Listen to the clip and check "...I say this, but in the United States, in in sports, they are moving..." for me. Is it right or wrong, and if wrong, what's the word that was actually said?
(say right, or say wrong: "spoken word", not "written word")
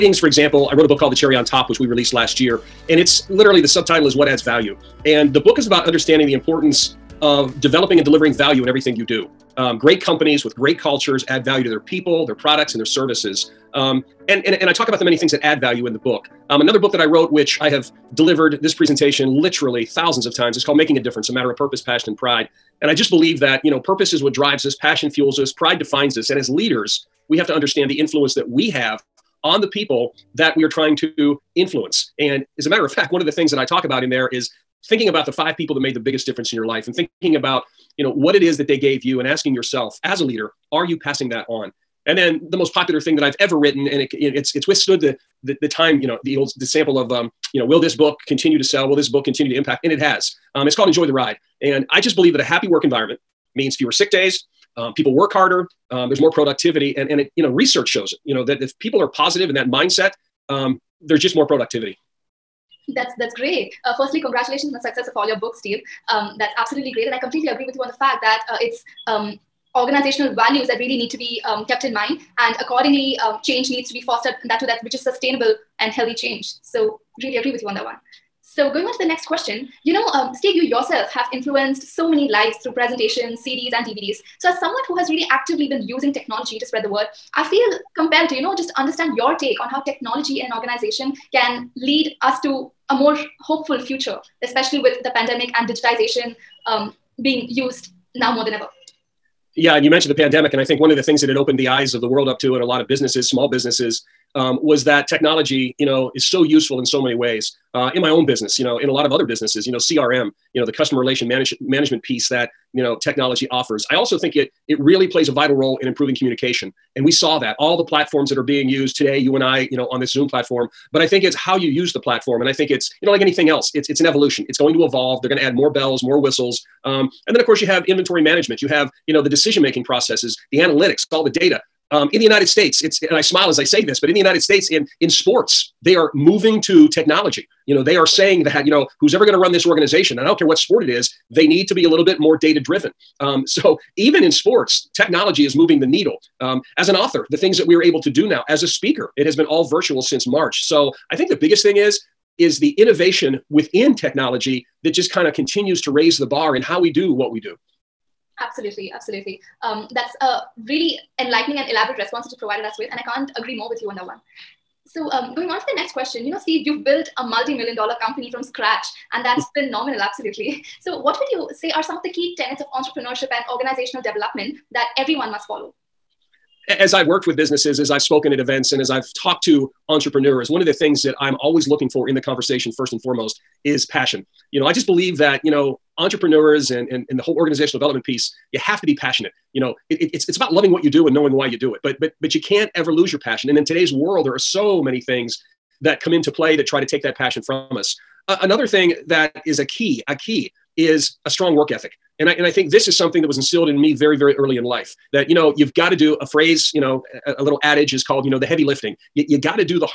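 right.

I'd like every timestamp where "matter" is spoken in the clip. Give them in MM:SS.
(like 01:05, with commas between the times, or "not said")
00:21, 00:32.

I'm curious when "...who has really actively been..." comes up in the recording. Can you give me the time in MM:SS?
01:24.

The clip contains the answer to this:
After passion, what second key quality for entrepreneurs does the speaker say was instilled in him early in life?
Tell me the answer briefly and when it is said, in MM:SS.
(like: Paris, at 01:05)
A strong work ethic, at 03:21.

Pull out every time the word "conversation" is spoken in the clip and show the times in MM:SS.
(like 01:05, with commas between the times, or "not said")
03:02.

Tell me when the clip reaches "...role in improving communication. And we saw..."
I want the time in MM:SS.
01:55.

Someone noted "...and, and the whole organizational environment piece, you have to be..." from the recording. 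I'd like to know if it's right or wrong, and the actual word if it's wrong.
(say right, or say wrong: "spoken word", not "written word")
wrong: "development", not "environment".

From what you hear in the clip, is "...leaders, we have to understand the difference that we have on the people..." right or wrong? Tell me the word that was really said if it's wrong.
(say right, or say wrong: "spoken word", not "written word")
wrong: "influence", not "difference".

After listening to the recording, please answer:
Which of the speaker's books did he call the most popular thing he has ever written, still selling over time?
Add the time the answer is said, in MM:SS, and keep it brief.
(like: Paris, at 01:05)
Enjoy the Ride, at 00:50.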